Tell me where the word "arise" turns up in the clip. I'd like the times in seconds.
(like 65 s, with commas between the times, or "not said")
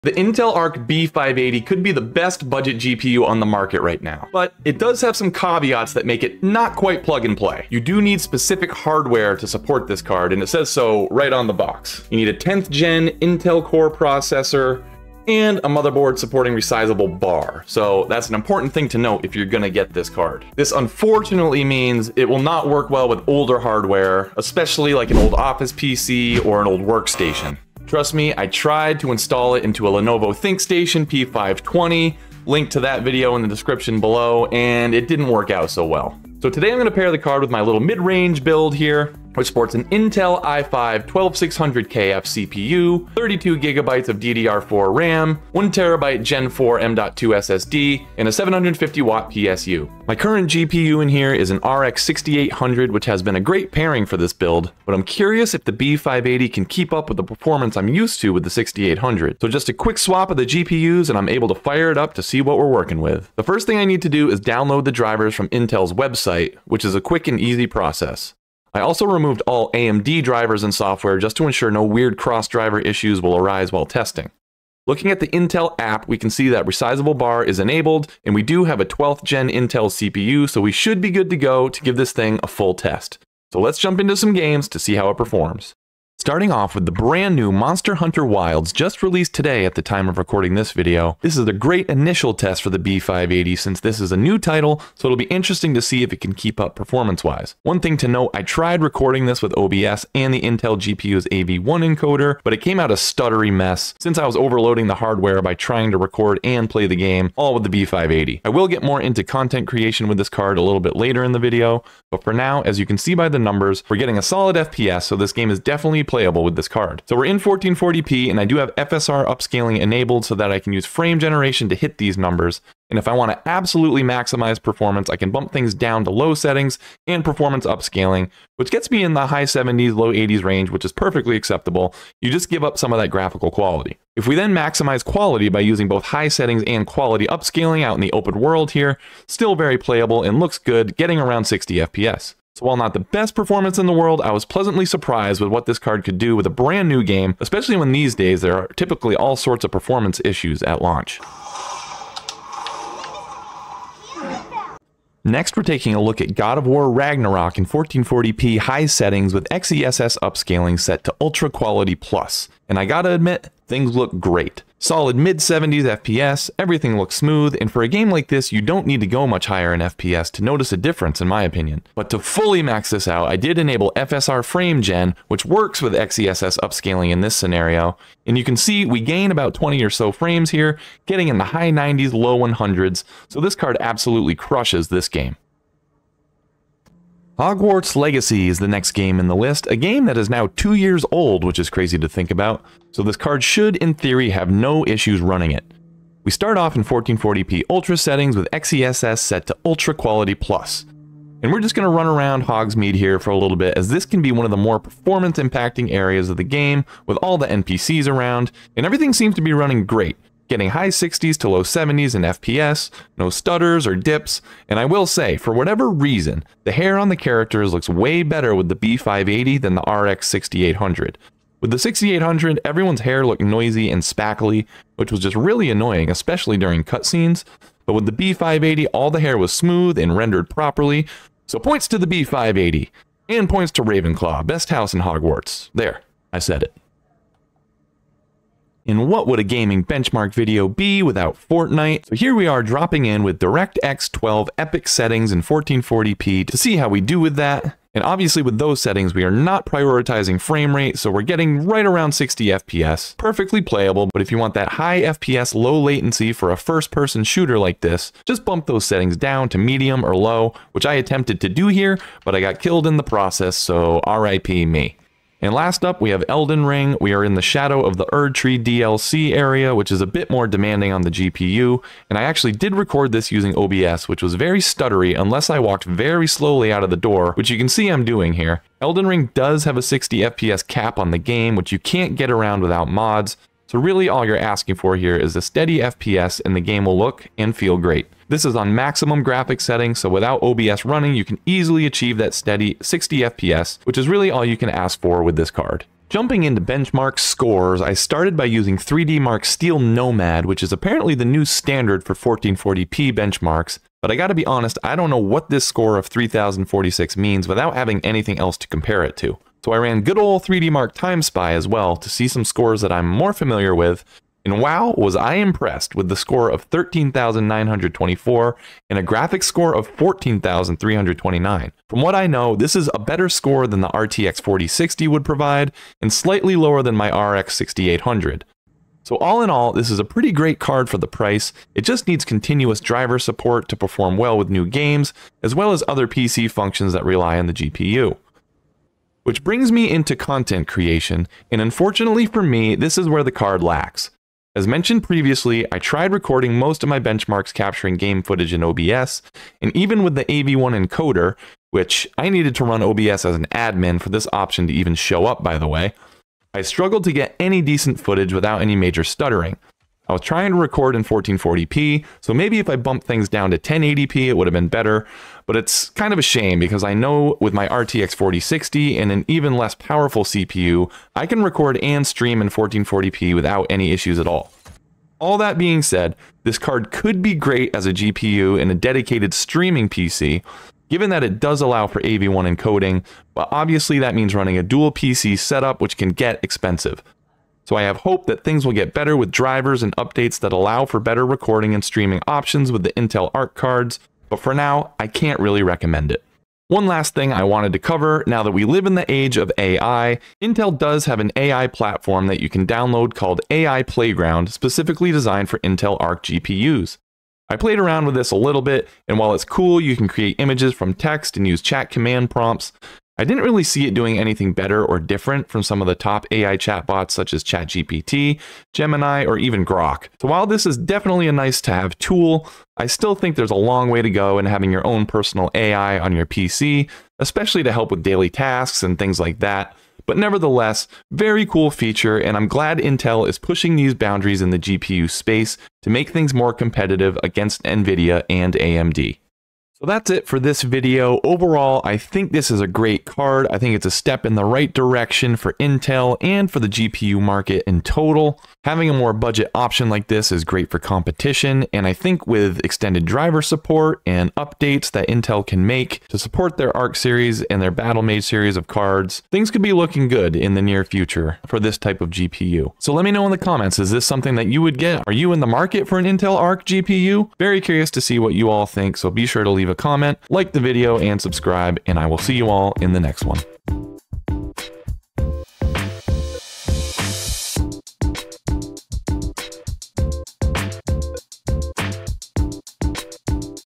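73 s.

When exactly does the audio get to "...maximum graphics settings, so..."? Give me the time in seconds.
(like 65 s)
288 s.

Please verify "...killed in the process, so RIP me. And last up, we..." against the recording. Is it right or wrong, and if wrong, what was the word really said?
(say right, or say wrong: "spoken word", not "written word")
right.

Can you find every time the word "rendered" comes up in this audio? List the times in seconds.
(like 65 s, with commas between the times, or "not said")
230 s.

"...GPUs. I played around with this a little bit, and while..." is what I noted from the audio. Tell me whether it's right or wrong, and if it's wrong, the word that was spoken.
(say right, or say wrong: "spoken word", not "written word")
right.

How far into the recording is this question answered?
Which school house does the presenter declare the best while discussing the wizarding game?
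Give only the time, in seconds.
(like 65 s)
233 s.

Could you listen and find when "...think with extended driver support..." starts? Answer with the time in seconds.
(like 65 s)
451 s.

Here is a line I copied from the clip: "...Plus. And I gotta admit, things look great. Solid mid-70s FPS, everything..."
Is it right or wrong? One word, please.
right.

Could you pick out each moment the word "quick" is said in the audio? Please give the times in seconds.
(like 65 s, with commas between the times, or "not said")
59 s, 67 s.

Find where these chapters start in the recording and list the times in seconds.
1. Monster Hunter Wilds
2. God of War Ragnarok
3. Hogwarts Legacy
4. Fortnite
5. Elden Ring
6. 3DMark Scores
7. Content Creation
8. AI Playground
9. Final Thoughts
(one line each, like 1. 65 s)
1. 85 s
2. 154 s
3. 186 s
4. 238 s
5. 265 s
6. 295 s
7. 328 s
8. 396 s
9. 439 s.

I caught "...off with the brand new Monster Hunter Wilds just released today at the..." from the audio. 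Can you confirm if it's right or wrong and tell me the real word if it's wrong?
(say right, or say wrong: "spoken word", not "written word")
right.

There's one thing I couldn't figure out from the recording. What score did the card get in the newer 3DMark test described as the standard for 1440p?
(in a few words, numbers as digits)
3046.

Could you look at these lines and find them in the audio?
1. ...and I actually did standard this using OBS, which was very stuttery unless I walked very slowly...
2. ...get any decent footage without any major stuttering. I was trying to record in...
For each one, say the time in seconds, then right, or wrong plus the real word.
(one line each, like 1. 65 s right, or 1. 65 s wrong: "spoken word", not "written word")
1. 272 s wrong: "record", not "standard"
2. 357 s right.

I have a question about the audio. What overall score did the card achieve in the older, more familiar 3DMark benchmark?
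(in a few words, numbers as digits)
13,924.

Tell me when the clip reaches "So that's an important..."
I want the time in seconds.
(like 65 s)
17 s.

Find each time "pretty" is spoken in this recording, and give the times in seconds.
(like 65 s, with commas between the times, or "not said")
330 s.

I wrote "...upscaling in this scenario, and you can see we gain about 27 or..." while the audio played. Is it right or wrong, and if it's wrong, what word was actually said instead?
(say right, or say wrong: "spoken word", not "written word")
wrong: "20", not "27".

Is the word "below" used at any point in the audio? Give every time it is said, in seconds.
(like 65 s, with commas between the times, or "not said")
33 s.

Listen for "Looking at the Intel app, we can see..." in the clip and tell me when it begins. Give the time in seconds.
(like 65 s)
74 s.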